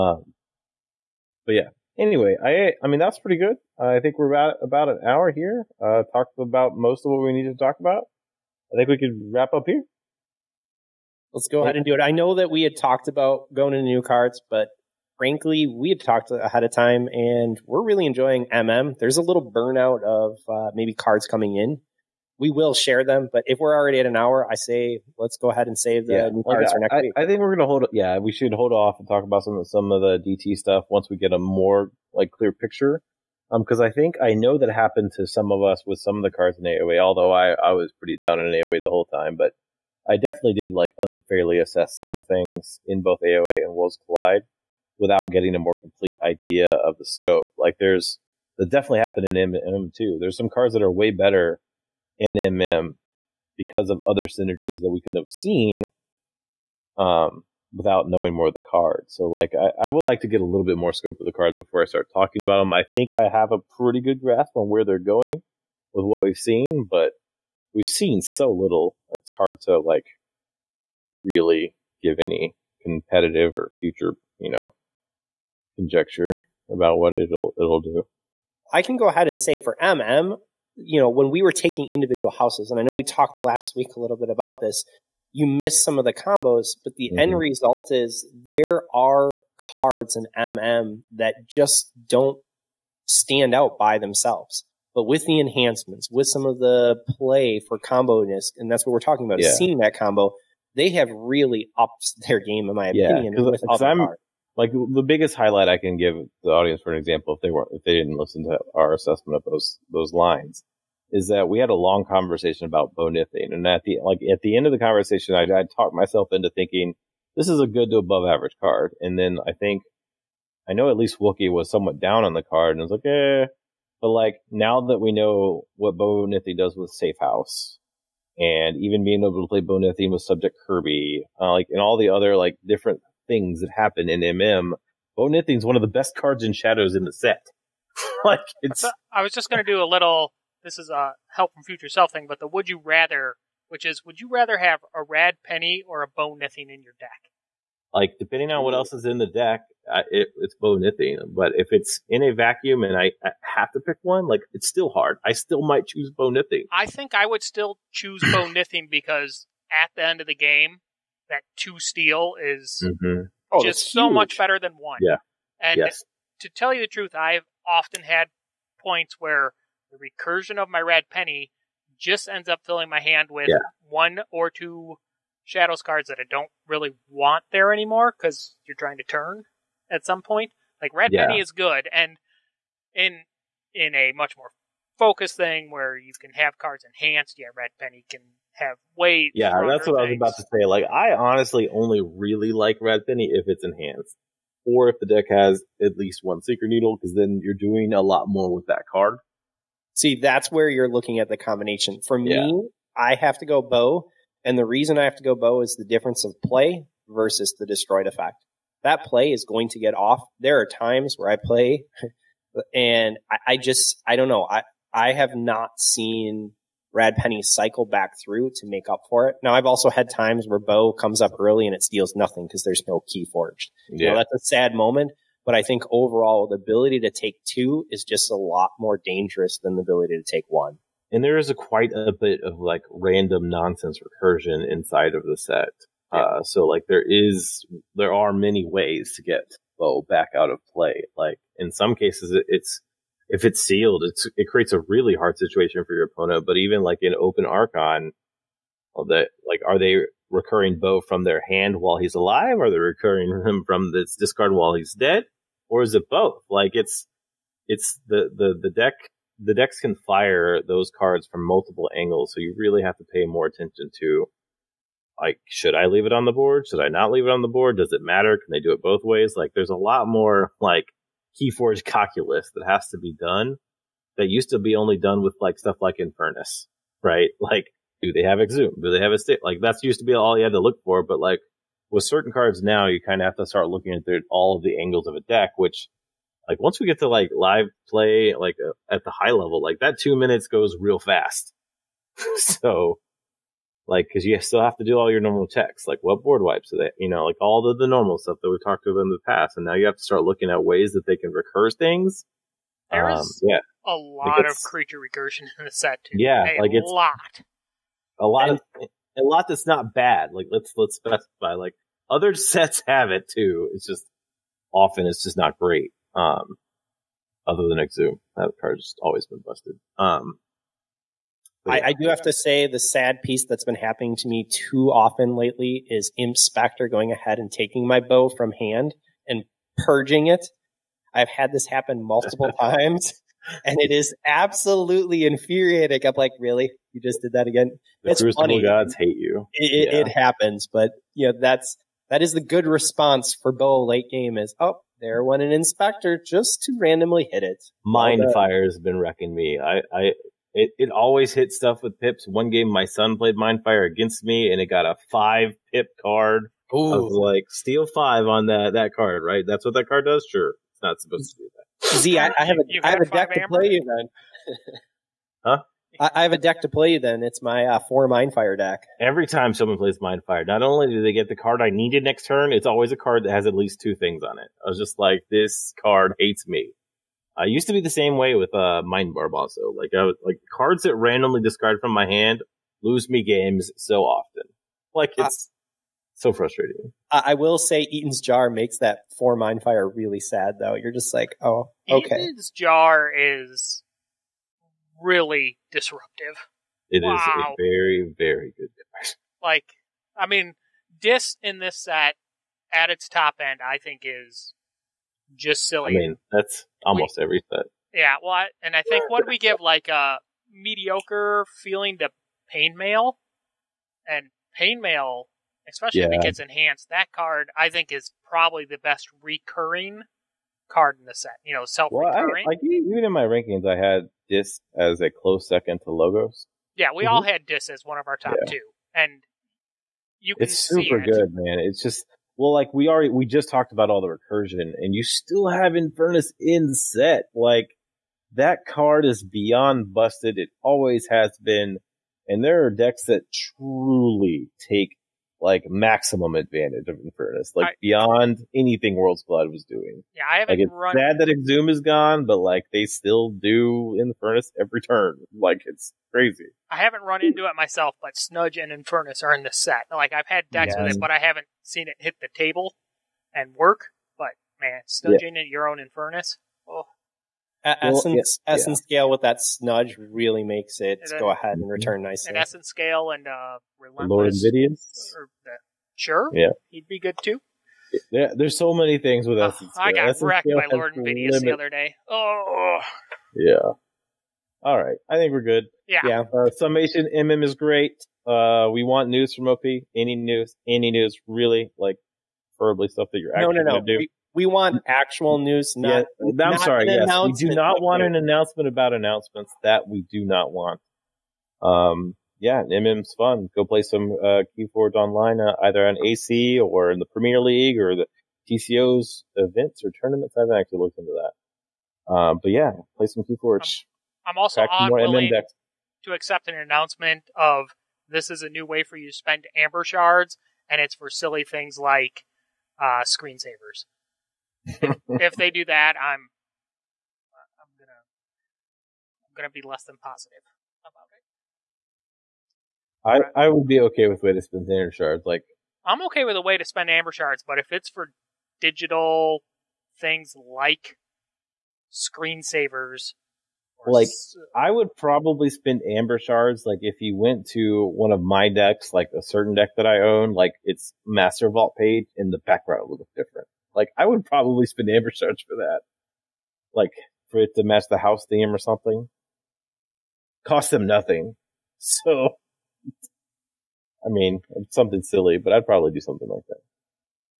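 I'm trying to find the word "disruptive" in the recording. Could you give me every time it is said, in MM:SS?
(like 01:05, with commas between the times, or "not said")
06:35.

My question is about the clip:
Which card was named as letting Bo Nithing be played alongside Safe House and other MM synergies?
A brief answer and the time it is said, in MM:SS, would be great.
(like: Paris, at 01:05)
Subject Kirby, at 02:10.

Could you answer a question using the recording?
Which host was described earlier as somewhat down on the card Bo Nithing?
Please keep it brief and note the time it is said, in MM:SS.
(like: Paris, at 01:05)
Wookie, at 02:01.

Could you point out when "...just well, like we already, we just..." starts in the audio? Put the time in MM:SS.
07:11.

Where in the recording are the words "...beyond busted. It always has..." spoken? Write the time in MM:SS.
07:19.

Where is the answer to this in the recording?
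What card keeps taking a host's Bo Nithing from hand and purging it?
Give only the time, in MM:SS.
05:26.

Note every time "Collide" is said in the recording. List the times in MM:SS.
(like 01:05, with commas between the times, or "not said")
00:44.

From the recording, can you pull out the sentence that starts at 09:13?
Like I would probably spend Amber Shards for that.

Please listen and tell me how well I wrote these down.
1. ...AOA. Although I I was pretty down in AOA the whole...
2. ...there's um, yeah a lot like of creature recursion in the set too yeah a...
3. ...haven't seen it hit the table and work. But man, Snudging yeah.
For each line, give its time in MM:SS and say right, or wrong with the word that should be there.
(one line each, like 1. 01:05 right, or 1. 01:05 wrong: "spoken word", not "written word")
1. 00:36 right
2. 05:02 right
3. 07:41 right.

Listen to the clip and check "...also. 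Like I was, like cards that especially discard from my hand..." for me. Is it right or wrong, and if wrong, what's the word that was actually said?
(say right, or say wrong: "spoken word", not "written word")
wrong: "randomly", not "especially".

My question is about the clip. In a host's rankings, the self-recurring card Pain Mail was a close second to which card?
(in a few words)
Logos.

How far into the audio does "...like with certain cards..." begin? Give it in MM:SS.
04:41.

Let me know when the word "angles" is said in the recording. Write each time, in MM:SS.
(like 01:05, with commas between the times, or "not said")
04:21, 04:44.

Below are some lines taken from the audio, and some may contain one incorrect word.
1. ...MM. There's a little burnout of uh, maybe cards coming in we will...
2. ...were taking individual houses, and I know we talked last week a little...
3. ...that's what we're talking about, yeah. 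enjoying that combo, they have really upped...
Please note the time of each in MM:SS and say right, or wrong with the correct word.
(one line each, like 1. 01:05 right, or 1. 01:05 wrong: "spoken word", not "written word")
1. 00:18 right
2. 01:21 right
3. 01:38 wrong: "seeing", not "enjoying".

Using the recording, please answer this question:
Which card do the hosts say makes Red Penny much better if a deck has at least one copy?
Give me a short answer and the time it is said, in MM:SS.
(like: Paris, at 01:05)
Secret Needle, at 03:16.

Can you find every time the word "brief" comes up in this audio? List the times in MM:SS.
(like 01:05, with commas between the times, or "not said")
not said.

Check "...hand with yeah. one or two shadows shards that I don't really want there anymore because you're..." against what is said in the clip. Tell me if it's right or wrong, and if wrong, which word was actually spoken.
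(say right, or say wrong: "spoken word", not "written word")
wrong: "cards", not "shards".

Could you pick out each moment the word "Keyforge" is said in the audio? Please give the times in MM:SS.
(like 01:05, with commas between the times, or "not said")
04:31.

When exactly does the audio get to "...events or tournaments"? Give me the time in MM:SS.
08:29.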